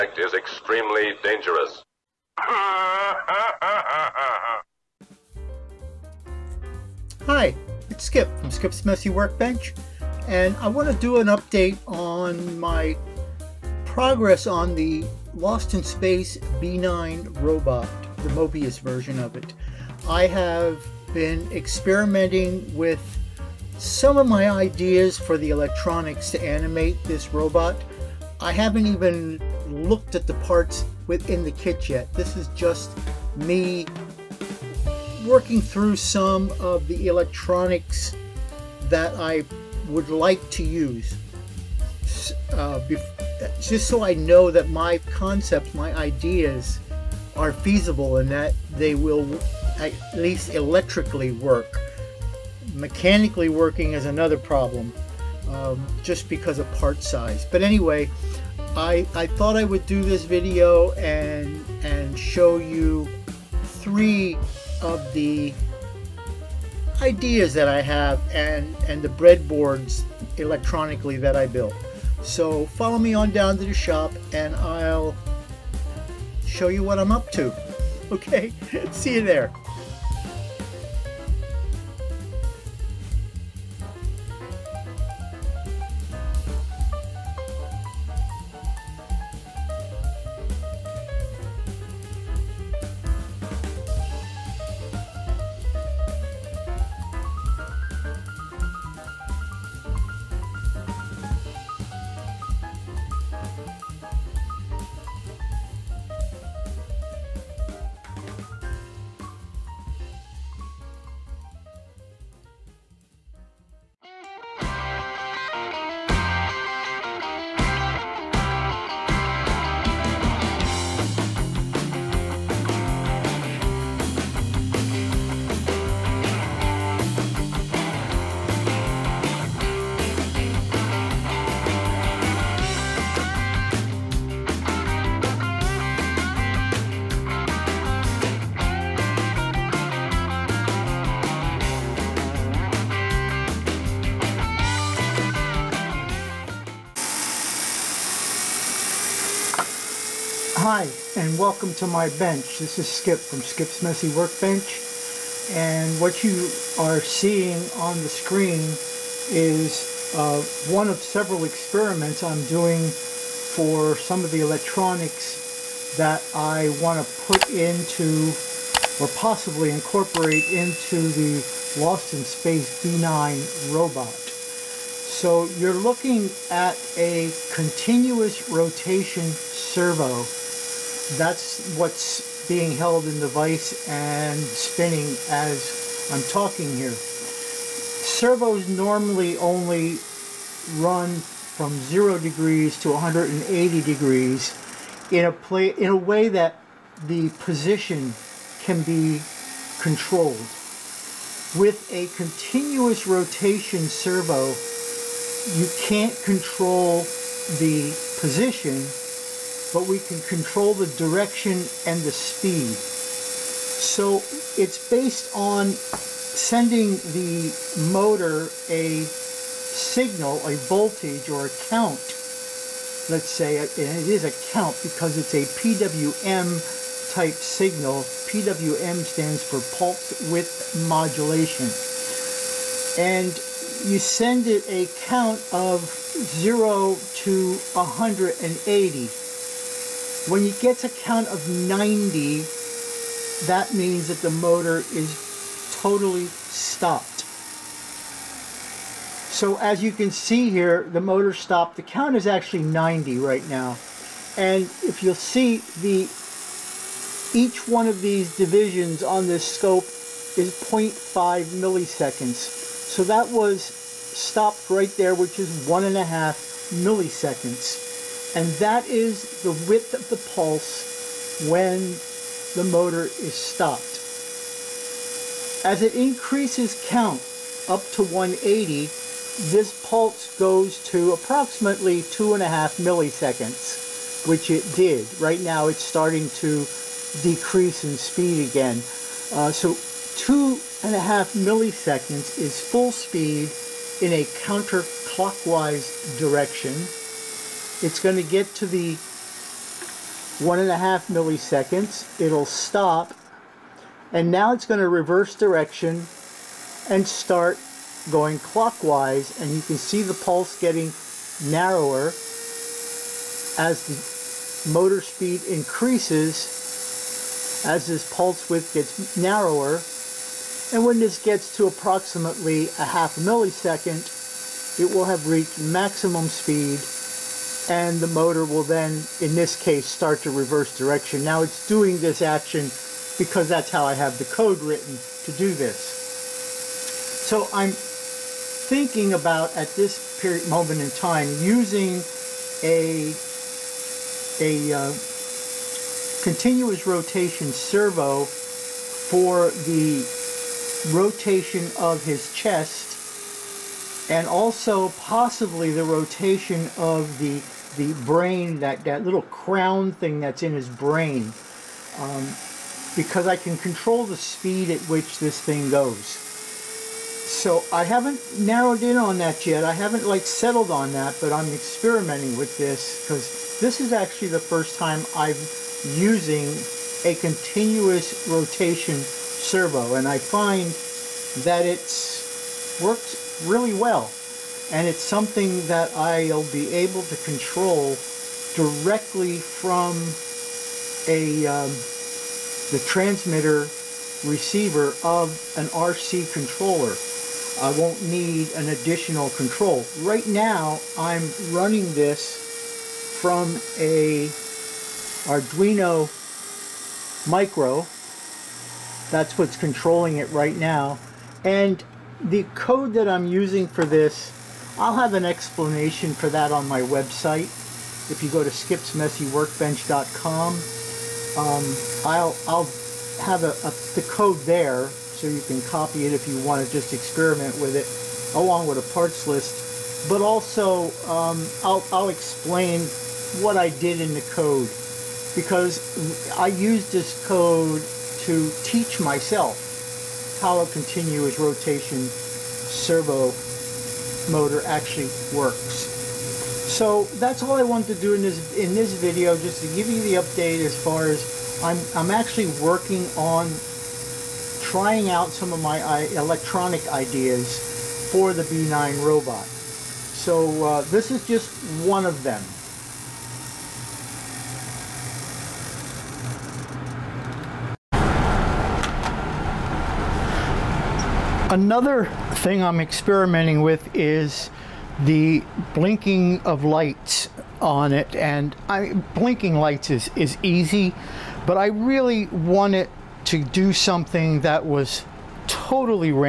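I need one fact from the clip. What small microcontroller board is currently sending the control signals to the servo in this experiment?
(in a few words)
Arduino Micro.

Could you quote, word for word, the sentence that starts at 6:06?
So I haven't narrowed in on that yet.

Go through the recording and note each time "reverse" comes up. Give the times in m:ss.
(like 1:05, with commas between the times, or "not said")
5:04, 5:30.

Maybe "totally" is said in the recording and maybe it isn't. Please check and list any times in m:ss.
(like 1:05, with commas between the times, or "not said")
4:05, 8:05.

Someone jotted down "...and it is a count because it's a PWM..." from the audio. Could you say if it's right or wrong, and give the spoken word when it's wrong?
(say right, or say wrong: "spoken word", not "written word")
right.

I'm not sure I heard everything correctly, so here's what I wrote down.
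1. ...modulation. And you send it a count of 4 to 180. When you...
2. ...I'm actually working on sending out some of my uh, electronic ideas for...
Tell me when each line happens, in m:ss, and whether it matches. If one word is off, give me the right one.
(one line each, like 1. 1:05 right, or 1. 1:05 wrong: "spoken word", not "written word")
1. 3:50 wrong: "0", not "4"
2. 7:31 wrong: "trying", not "sending".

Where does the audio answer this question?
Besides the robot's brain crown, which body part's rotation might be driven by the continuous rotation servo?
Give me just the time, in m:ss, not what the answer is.
5:52.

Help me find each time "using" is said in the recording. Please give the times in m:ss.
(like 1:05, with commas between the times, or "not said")
5:41, 6:15, 6:53.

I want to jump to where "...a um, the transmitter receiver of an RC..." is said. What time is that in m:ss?
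6:31.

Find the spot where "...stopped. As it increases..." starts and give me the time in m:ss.
4:33.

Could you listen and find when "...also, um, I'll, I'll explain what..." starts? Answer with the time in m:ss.
7:10.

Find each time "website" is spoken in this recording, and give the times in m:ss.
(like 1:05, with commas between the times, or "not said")
6:56.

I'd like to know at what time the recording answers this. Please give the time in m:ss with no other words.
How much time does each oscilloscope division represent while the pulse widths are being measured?
4:20.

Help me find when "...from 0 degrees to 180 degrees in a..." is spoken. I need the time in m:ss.
3:11.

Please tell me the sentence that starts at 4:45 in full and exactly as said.
Right now it's starting to decrease in speed again.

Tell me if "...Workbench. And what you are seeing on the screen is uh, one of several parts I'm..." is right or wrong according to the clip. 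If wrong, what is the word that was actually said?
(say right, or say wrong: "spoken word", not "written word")
wrong: "experiments", not "parts".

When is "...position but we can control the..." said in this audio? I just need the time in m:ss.
3:28.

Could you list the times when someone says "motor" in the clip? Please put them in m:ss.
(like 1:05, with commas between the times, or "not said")
3:37, 4:04, 4:10, 4:32, 5:14, 5:28, 7:24.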